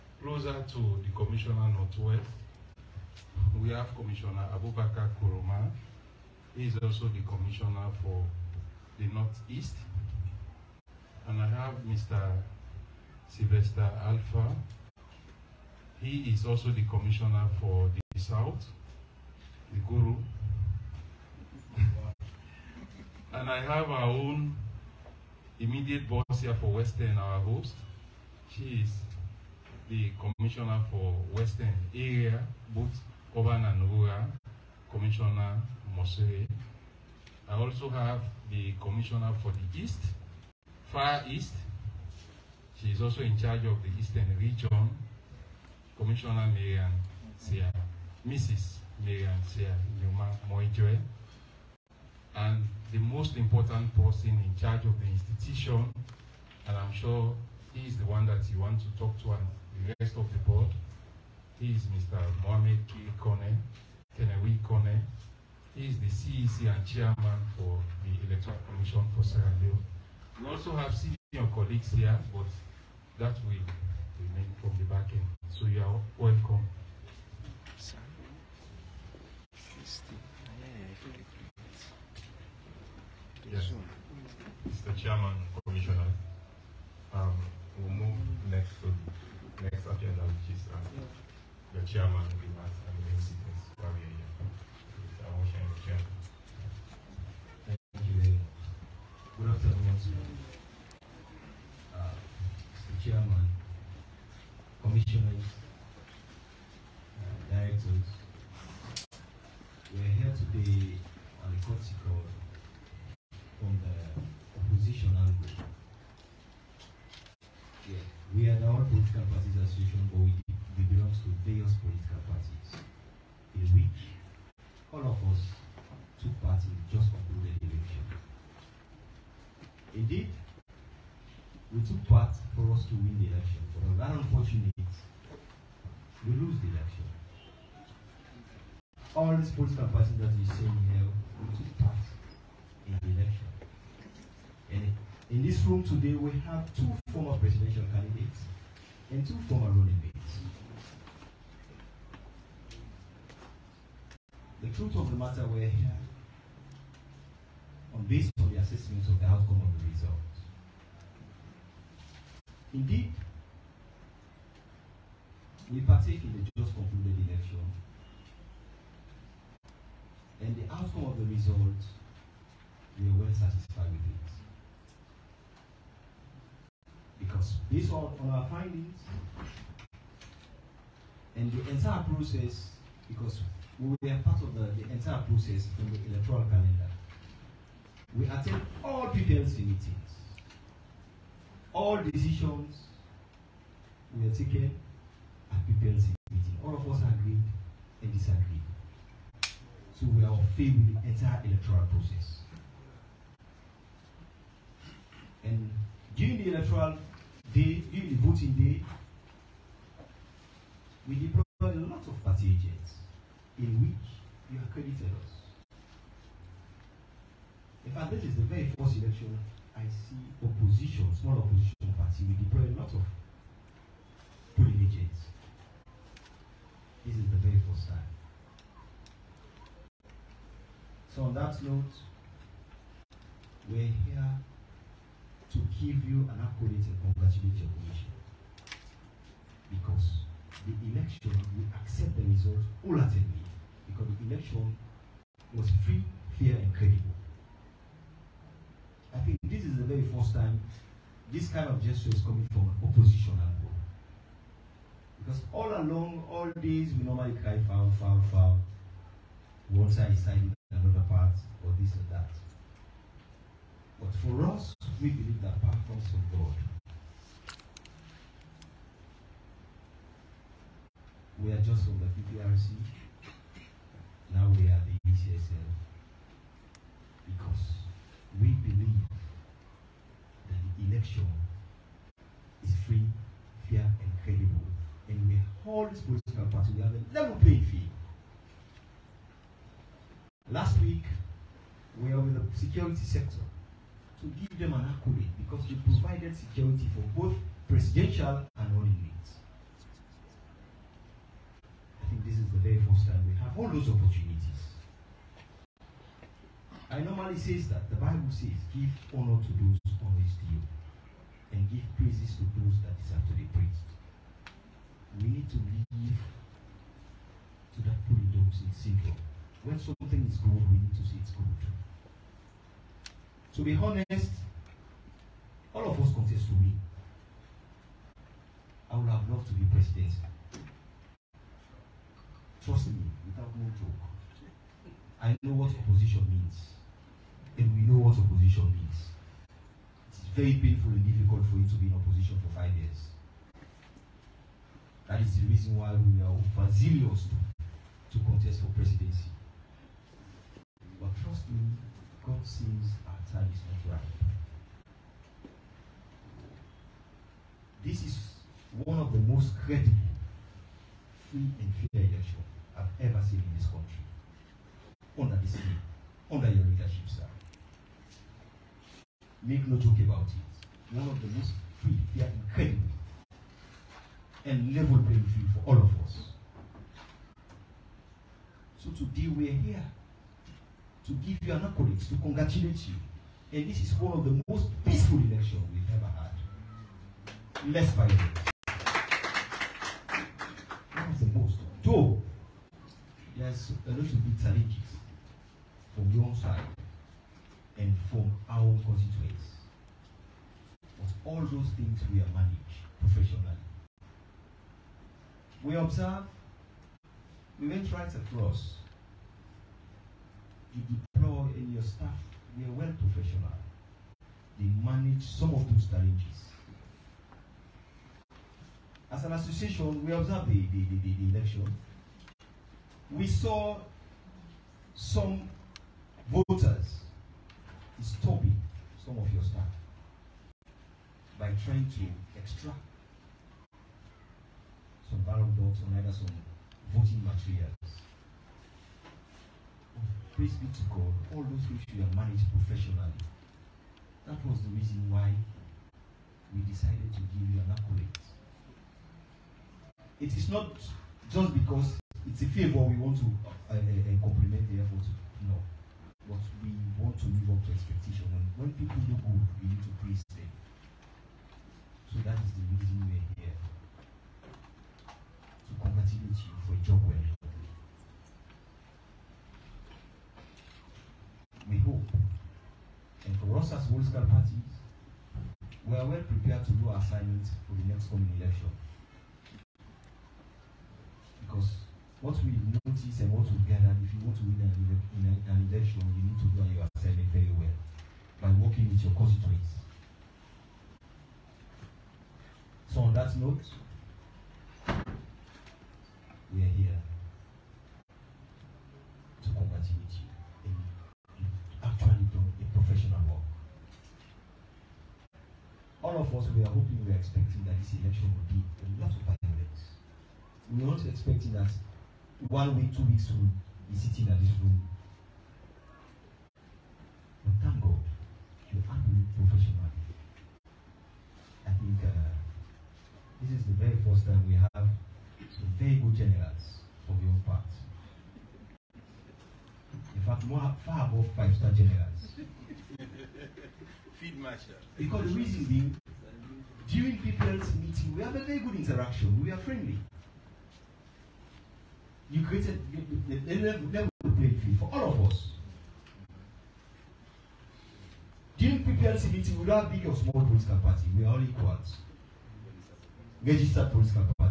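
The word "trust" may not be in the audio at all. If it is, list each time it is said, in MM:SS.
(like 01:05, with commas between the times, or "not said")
05:32, 05:51.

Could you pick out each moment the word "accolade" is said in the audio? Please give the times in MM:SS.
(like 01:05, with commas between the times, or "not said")
03:56, 04:54, 06:21, 07:27.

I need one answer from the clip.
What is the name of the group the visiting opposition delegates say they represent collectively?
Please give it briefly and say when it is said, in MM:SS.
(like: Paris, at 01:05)
All Political Parties Association, at 01:58.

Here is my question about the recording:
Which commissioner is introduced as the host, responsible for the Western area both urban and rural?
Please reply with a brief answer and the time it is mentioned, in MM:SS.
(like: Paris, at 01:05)
Commissioner Moseray, at 00:34.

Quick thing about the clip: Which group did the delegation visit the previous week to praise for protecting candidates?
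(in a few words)
security sector.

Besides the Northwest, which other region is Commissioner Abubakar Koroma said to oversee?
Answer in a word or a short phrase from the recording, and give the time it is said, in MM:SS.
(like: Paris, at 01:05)
Northeast, at 00:09.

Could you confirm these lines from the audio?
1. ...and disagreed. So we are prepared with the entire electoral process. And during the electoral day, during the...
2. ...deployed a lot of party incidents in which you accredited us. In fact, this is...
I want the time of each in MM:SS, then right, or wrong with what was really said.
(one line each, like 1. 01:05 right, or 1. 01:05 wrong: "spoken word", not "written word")
1. 03:18 wrong: "failed", not "prepared"
2. 03:31 wrong: "agents", not "incidents".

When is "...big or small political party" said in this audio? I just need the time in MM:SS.
09:09.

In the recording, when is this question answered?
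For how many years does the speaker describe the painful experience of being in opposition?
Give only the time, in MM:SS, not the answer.
05:42.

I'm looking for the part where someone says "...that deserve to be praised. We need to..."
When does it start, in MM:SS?
05:12.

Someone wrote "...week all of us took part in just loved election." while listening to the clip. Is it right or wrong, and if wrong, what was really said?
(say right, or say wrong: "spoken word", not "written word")
wrong: "concluded", not "loved".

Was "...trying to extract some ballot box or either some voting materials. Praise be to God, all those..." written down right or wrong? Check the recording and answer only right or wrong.
right.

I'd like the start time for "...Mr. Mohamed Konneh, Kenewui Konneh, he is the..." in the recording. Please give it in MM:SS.
01:01.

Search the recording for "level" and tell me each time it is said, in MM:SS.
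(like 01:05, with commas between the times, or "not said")
04:47, 06:14, 09:03.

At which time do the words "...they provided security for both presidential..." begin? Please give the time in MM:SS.
04:55.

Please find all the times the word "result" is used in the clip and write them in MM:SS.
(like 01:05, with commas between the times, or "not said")
02:39, 02:51, 04:02.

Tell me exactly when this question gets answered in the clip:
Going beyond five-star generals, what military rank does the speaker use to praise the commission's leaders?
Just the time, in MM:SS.
08:54.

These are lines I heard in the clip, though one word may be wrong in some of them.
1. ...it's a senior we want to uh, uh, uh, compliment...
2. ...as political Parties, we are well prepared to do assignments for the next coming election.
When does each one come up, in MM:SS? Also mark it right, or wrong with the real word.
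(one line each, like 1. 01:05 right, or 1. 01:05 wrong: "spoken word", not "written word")
1. 07:32 wrong: "favor", not "senior"
2. 07:53 right.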